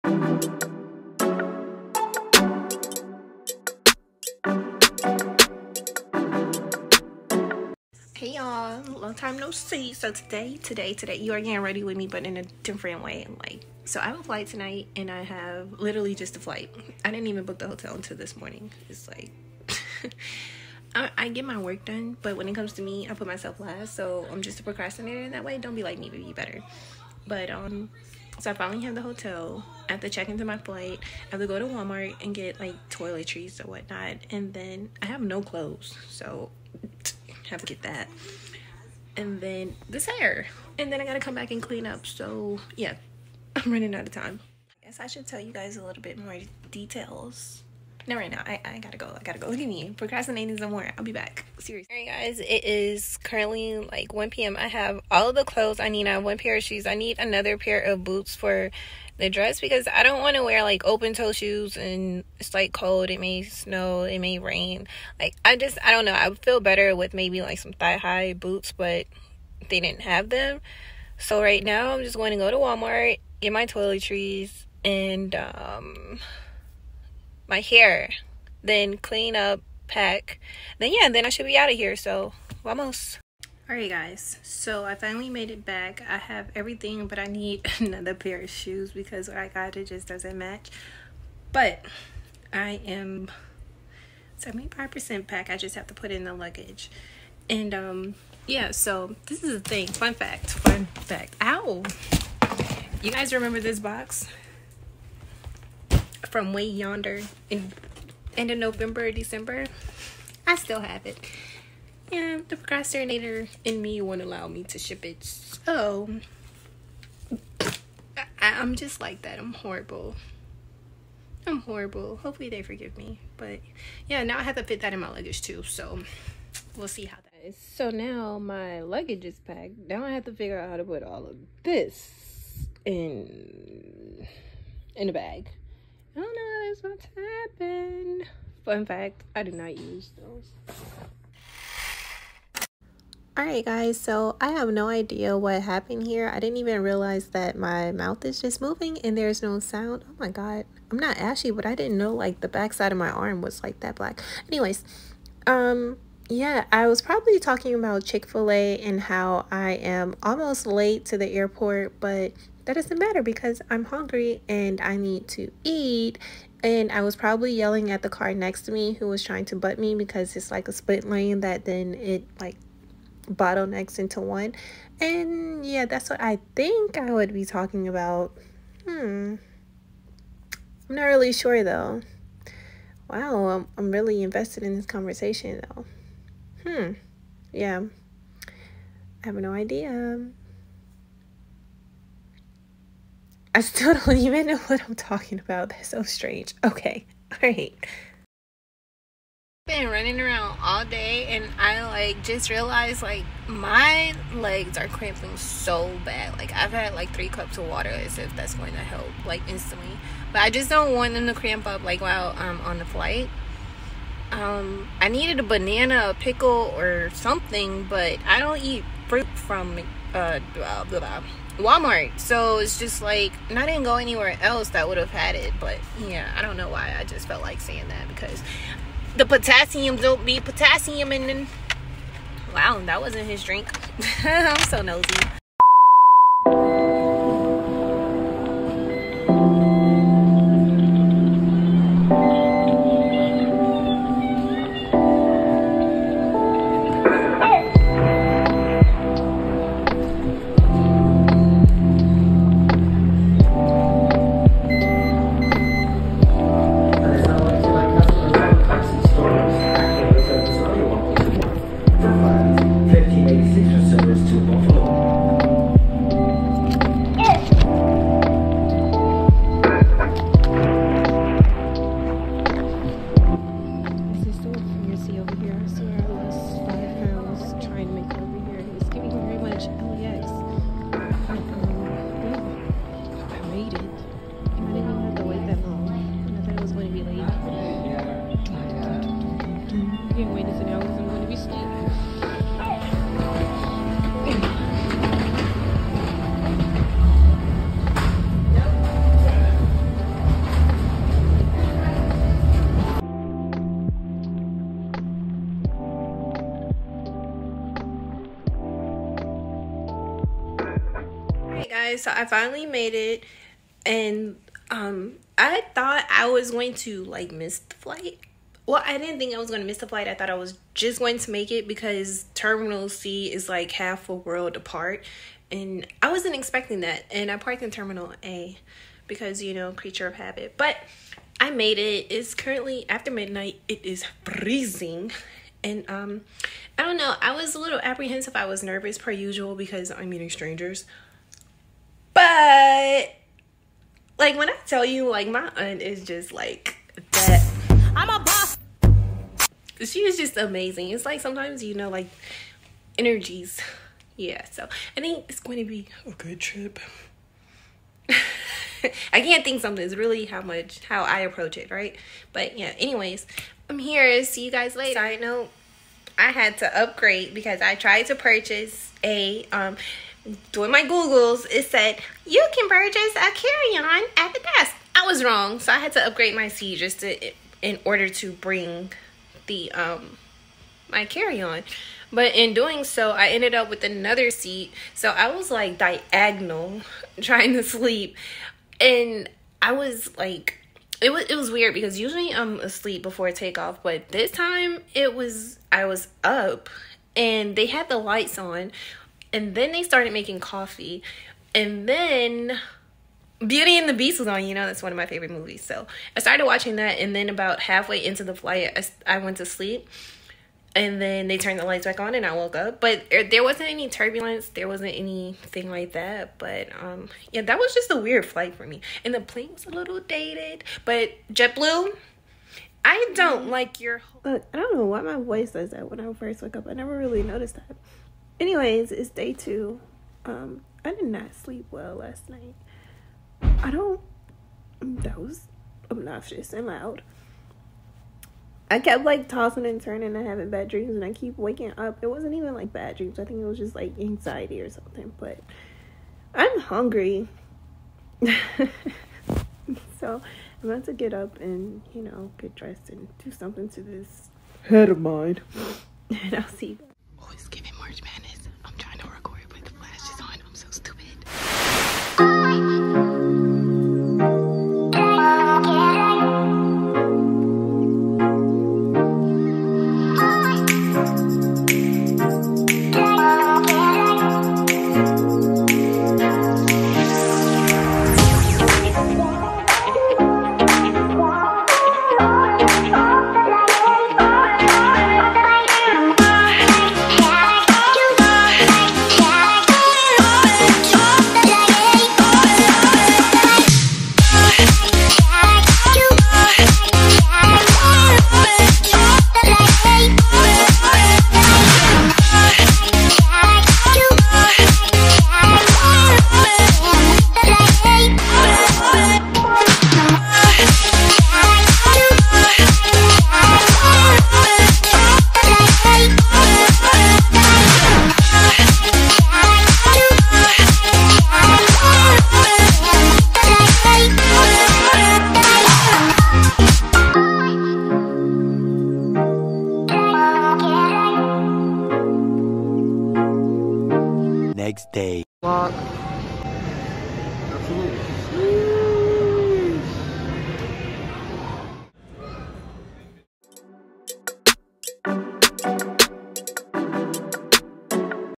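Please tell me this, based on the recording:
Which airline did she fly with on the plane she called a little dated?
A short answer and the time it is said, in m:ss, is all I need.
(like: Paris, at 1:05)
JetBlue, at 7:01.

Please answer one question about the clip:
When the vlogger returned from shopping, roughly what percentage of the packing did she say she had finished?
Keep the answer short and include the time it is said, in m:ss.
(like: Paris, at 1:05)
75%, at 1:34.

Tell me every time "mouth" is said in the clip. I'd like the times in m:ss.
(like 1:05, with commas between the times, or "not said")
2:27.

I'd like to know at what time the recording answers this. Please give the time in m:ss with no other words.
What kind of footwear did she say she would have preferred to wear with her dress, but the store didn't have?
1:07.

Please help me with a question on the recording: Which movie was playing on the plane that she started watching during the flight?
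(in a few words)
Beauty and the Beast.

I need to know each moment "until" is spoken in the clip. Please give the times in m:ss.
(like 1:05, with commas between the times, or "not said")
0:17.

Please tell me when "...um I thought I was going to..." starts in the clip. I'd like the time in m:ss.
5:14.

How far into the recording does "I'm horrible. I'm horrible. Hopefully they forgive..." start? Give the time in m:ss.
1:59.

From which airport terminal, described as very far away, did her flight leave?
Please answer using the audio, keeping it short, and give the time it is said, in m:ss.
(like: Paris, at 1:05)
Terminal C, at 5:22.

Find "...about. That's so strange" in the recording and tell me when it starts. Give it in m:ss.
3:15.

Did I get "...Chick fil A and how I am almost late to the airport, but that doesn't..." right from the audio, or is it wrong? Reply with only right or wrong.
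right.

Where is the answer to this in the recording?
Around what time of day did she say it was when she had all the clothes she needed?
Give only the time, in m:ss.
0:54.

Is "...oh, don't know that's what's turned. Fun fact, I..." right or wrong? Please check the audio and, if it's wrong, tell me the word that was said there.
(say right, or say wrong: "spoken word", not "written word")
wrong: "happened", not "turned".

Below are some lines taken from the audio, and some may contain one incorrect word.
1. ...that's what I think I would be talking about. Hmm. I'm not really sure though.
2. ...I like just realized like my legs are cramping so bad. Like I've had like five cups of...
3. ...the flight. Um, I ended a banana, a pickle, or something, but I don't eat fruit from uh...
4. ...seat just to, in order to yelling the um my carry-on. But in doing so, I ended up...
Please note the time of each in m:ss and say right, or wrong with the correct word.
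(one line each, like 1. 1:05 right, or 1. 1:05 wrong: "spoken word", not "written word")
1. 2:55 right
2. 3:21 wrong: "three", not "five"
3. 3:32 wrong: "needed", not "ended"
4. 6:16 wrong: "bring", not "yelling".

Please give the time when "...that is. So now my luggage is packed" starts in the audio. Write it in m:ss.
2:07.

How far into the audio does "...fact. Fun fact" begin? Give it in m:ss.
1:40.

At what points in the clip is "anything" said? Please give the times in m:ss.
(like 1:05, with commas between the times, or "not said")
6:54.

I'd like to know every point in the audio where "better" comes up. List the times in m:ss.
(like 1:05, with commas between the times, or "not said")
0:26, 1:06.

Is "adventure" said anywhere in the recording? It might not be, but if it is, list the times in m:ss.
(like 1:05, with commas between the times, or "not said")
not said.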